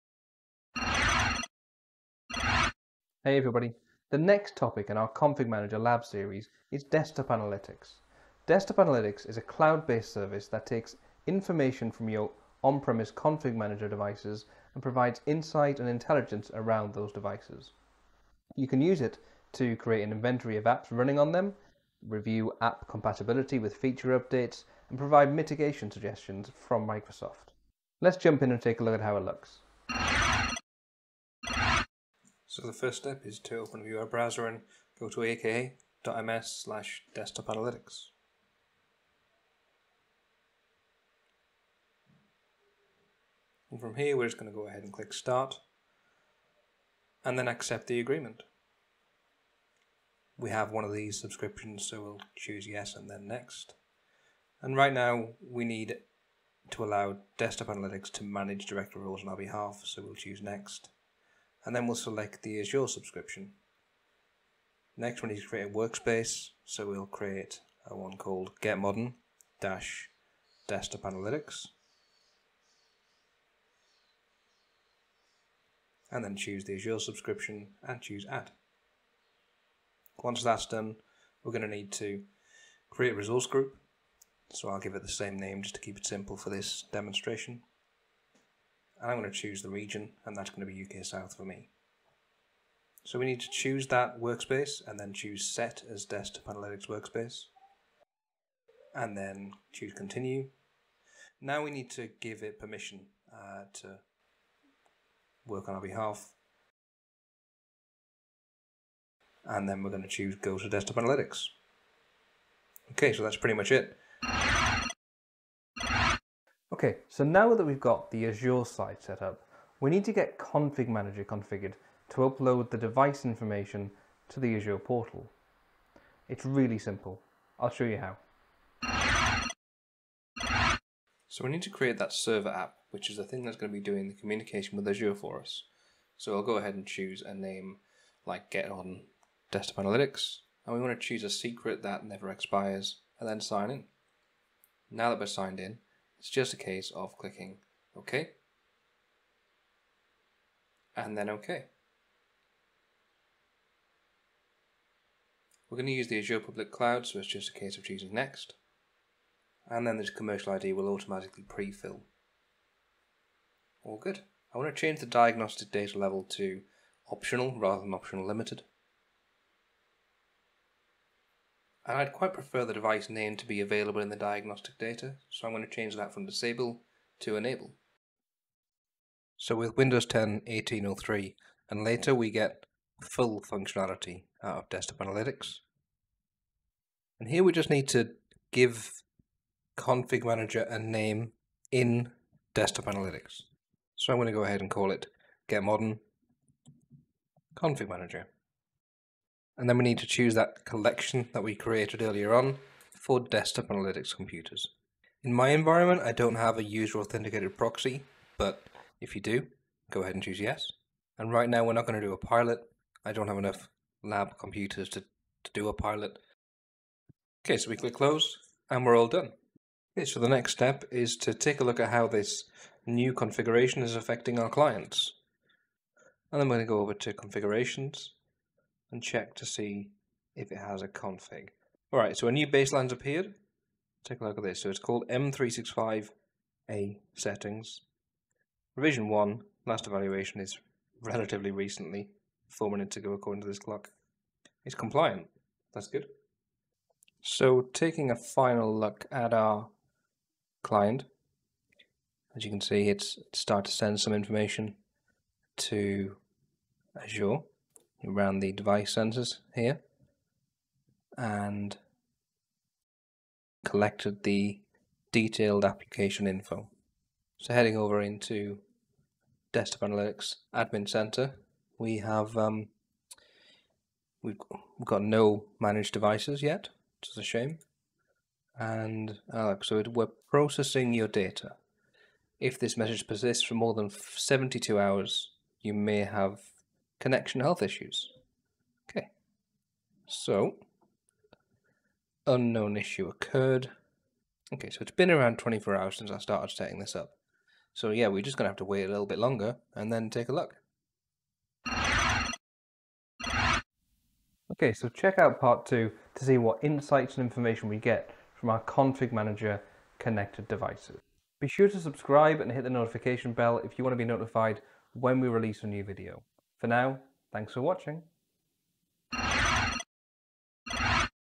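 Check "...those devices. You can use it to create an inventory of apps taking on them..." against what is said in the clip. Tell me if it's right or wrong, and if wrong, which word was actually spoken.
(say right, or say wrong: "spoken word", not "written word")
wrong: "running", not "taking".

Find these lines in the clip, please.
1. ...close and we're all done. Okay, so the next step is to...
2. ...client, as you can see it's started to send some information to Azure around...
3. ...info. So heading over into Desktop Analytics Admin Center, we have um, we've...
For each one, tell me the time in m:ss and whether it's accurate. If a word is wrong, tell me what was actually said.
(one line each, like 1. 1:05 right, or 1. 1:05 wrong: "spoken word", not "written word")
1. 3:37 right
2. 4:10 right
3. 4:26 right.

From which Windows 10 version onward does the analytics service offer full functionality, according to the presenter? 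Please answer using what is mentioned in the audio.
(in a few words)
1803.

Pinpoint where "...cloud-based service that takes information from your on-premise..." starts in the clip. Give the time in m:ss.
0:09.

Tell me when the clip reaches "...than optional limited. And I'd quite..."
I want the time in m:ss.
2:47.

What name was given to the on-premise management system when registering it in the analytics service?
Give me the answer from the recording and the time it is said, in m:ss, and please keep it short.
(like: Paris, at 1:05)
Get Modern Config Manager, at 3:15.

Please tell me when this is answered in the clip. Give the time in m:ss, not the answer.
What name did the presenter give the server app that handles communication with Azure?
2:18.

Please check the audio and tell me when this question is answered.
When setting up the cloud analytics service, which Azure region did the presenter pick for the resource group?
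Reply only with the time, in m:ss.
1:30.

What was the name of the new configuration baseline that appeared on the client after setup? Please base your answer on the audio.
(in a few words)
M365A settings.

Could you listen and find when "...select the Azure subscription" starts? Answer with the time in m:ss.
1:01.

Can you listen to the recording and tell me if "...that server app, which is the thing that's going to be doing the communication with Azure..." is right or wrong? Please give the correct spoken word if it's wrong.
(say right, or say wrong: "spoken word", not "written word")
right.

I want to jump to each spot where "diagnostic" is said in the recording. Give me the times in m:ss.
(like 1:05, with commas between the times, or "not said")
2:45, 2:54.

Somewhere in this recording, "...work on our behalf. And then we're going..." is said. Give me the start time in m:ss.
1:45.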